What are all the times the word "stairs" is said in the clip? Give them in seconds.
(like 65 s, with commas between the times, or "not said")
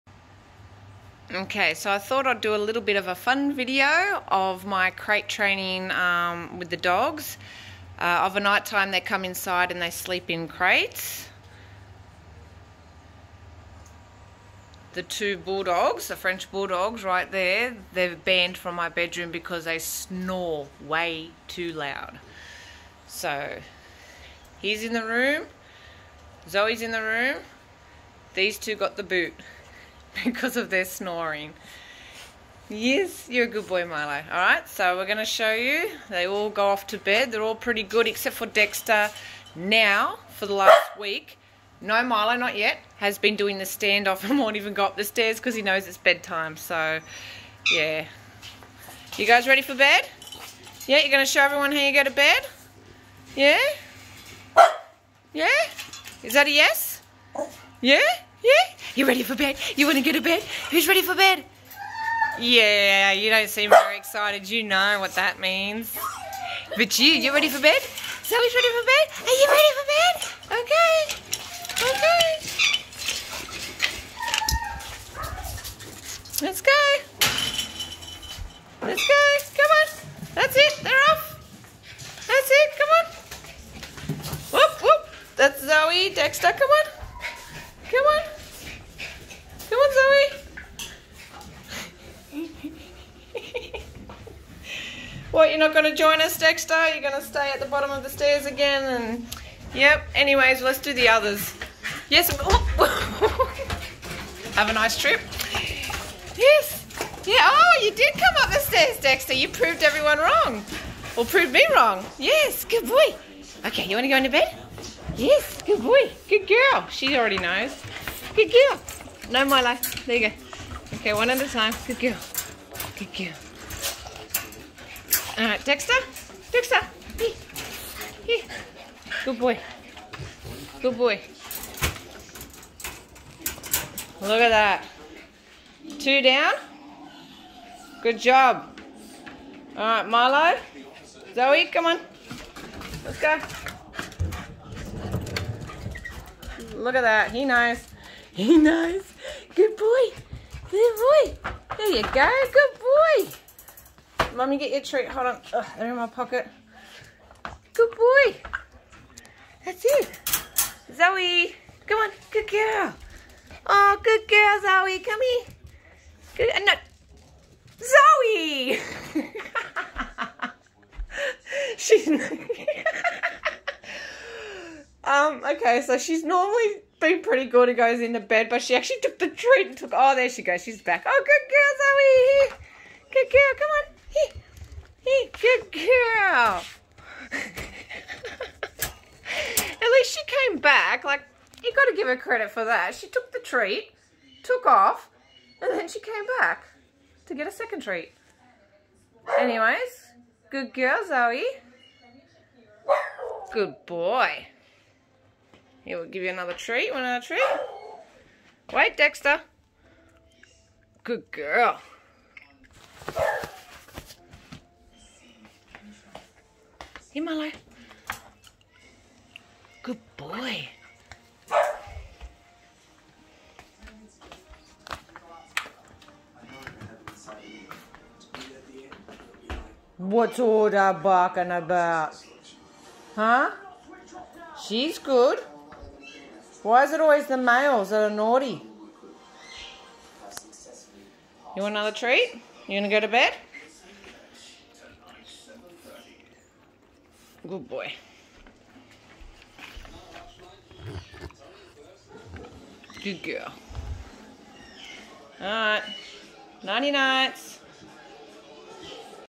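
45 s, 98 s, 108 s.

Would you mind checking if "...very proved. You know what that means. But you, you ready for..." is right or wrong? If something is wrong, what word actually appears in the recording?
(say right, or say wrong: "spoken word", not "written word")
wrong: "excited", not "proved".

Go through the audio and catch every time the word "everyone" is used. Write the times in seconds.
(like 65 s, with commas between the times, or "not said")
51 s, 109 s.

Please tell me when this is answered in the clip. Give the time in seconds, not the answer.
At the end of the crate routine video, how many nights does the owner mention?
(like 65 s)
256 s.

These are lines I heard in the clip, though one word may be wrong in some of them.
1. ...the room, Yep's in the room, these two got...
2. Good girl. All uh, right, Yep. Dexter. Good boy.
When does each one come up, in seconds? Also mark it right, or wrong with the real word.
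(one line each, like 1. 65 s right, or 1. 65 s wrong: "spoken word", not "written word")
1. 24 s wrong: "Zoe", not "Yep"
2. 122 s wrong: "Dexter", not "Yep".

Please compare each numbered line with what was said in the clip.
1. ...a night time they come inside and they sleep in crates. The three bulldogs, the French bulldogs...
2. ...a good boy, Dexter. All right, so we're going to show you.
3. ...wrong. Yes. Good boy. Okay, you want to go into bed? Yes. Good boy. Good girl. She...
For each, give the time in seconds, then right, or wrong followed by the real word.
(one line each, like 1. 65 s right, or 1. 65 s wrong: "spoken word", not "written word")
1. 8 s wrong: "two", not "three"
2. 33 s wrong: "Milo", not "Dexter"
3. 111 s right.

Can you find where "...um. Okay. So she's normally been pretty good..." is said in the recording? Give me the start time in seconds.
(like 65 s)
175 s.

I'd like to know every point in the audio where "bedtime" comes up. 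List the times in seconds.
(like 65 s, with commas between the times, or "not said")
45 s.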